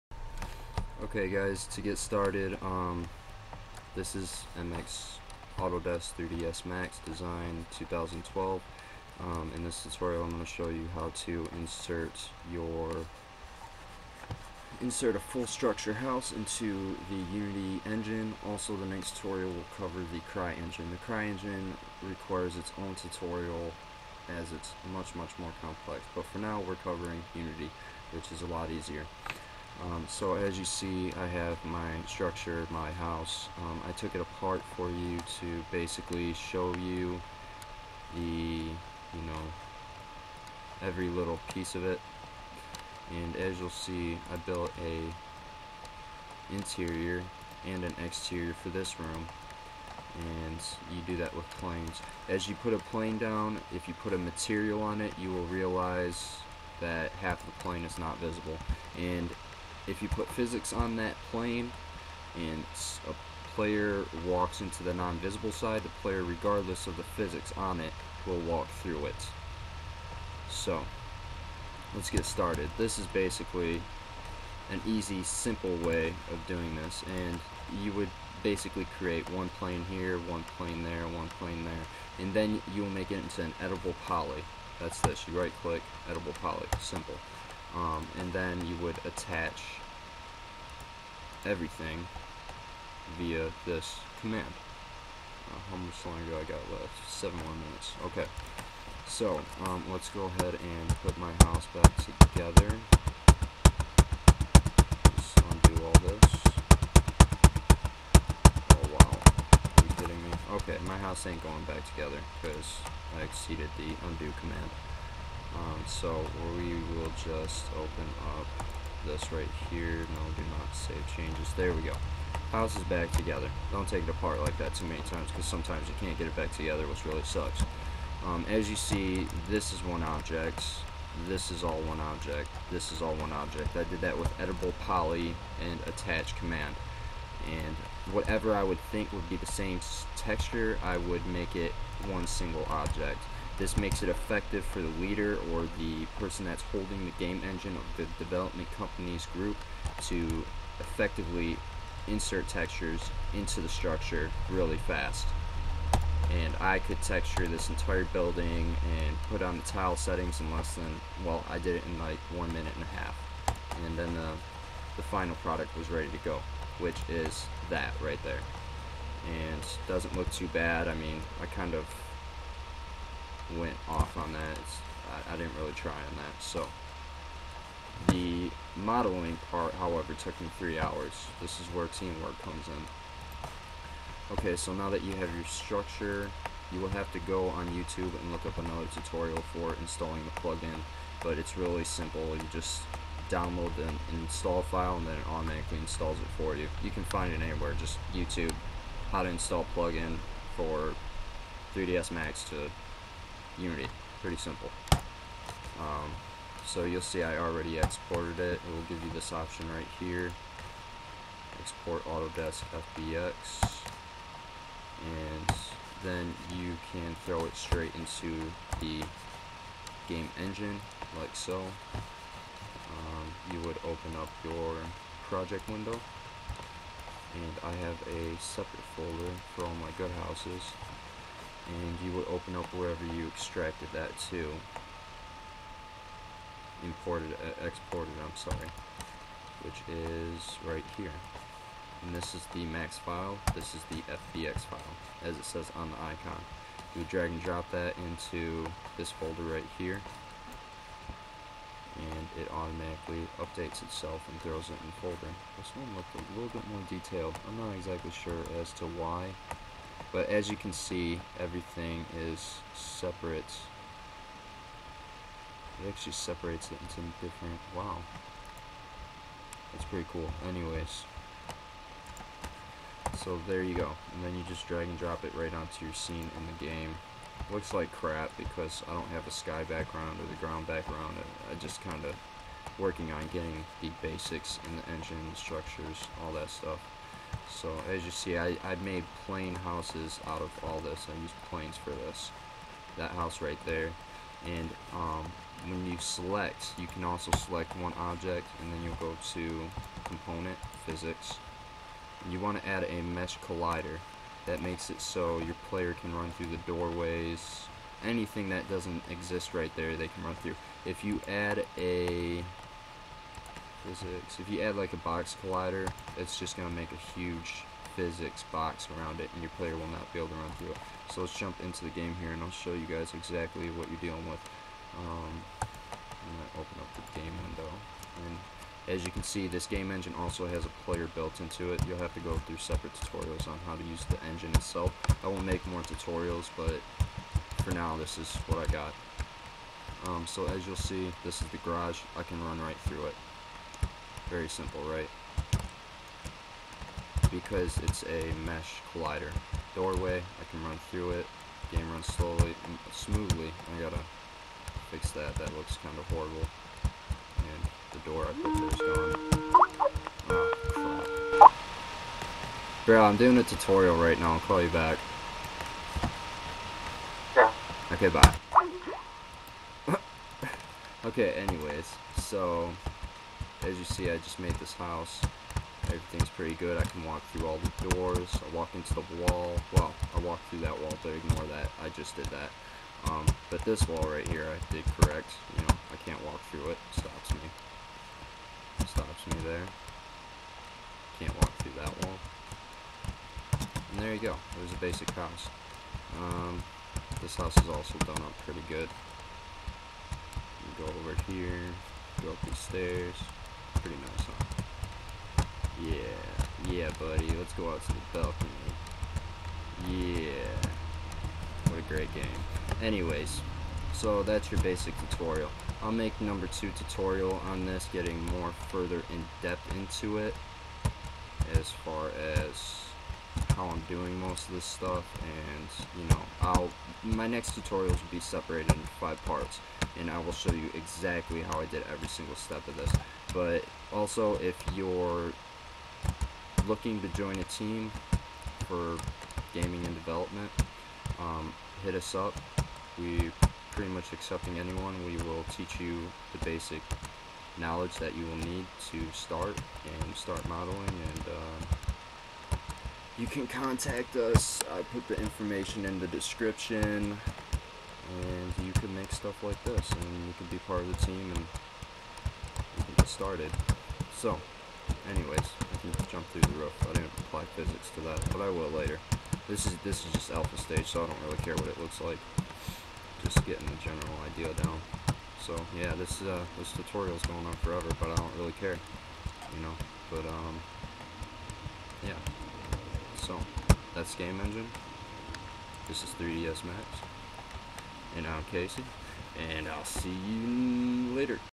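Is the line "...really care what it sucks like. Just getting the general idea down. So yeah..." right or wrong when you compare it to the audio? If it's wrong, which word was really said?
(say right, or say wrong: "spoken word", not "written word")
wrong: "looks", not "sucks".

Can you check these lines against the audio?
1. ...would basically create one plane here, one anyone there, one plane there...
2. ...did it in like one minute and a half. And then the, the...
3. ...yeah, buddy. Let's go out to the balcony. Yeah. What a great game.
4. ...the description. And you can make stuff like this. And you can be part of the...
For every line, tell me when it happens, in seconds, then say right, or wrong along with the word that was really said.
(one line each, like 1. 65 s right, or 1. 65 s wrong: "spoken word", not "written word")
1. 77 s wrong: "plane", not "anyone"
2. 161 s right
3. 406 s right
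4. 455 s right.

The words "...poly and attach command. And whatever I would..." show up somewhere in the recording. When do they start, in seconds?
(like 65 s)
134 s.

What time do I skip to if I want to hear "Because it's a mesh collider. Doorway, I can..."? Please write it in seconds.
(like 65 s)
347 s.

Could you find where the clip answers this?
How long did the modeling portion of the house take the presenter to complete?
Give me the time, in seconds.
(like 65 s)
180 s.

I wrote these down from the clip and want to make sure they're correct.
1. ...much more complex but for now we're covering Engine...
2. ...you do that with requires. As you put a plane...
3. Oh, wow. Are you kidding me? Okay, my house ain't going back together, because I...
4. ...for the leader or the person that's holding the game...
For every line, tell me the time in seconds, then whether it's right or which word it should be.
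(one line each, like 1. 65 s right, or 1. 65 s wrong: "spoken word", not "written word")
1. 25 s wrong: "Unity", not "Engine"
2. 50 s wrong: "planes", not "requires"
3. 108 s right
4. 144 s right.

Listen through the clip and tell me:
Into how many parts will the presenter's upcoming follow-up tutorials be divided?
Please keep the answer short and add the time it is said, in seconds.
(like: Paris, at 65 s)
5, at 428 s.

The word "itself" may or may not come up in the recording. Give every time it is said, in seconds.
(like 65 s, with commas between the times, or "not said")
253 s, 334 s.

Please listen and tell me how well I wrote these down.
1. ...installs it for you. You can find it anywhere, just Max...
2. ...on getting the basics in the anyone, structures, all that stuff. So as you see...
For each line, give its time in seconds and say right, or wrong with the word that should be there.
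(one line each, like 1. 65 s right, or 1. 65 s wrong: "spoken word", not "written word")
1. 195 s wrong: "YouTube", not "Max"
2. 283 s wrong: "engine", not "anyone".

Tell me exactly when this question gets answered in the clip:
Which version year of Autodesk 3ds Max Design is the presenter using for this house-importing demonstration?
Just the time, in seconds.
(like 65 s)
7 s.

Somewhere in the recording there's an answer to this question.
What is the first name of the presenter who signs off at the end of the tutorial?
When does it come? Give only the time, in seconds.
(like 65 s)
488 s.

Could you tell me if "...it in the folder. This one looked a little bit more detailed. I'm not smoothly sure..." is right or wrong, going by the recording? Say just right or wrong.
wrong.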